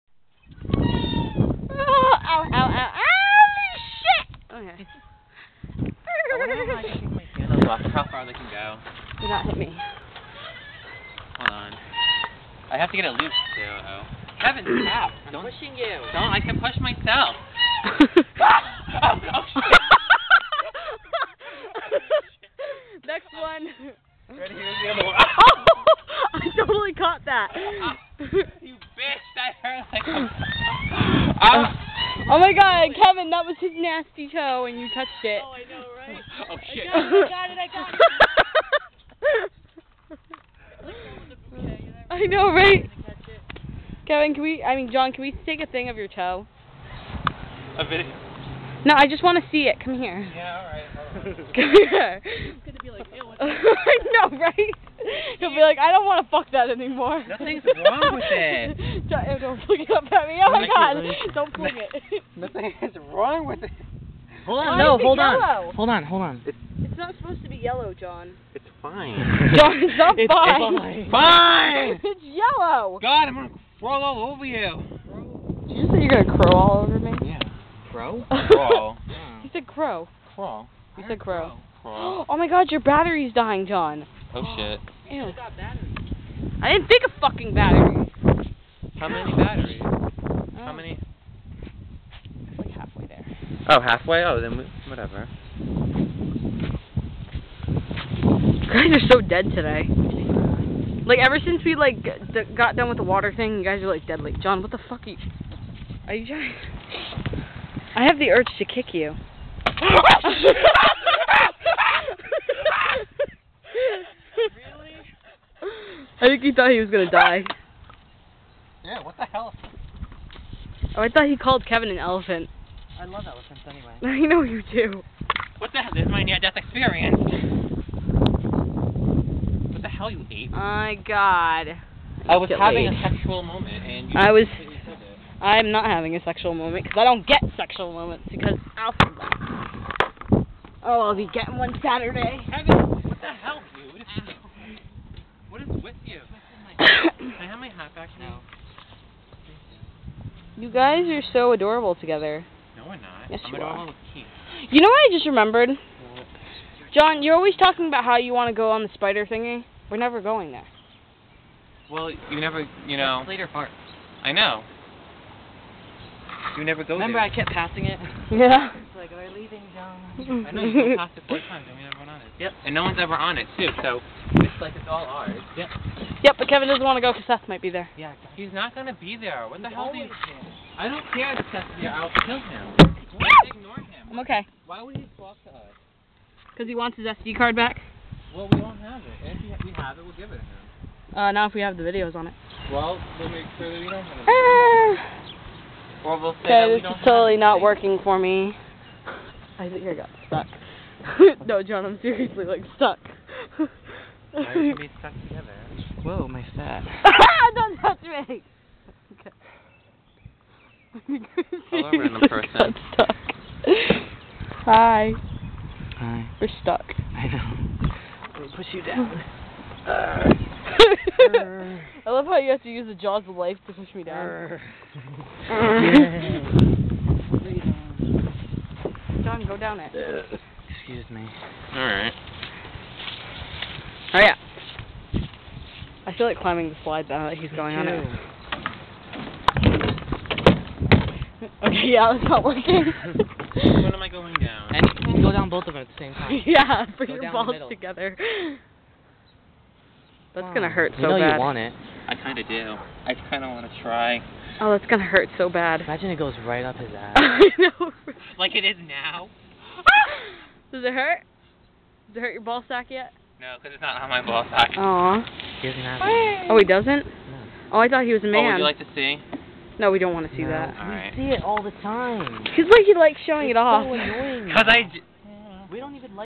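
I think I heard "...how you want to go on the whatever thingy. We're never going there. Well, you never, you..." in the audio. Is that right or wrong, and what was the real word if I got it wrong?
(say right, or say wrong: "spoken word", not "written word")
wrong: "spider", not "whatever".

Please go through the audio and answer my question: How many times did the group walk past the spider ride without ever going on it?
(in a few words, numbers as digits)
4.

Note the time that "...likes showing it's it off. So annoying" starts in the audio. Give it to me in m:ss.
4:32.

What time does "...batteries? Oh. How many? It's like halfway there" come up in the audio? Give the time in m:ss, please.
1:29.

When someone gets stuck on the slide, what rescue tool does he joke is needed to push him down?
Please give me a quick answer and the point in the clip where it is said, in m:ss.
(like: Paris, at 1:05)
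Jaws of life, at 3:42.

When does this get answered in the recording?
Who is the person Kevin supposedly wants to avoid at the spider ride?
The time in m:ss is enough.
2:57.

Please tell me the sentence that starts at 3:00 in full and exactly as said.
I don't care if Sesame, I'll kill him.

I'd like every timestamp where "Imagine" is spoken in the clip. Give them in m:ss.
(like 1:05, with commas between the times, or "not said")
4:15.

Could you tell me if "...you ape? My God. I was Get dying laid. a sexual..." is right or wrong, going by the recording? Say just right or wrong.
wrong.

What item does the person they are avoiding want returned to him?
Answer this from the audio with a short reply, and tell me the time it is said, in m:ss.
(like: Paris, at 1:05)
SD card, at 3:07.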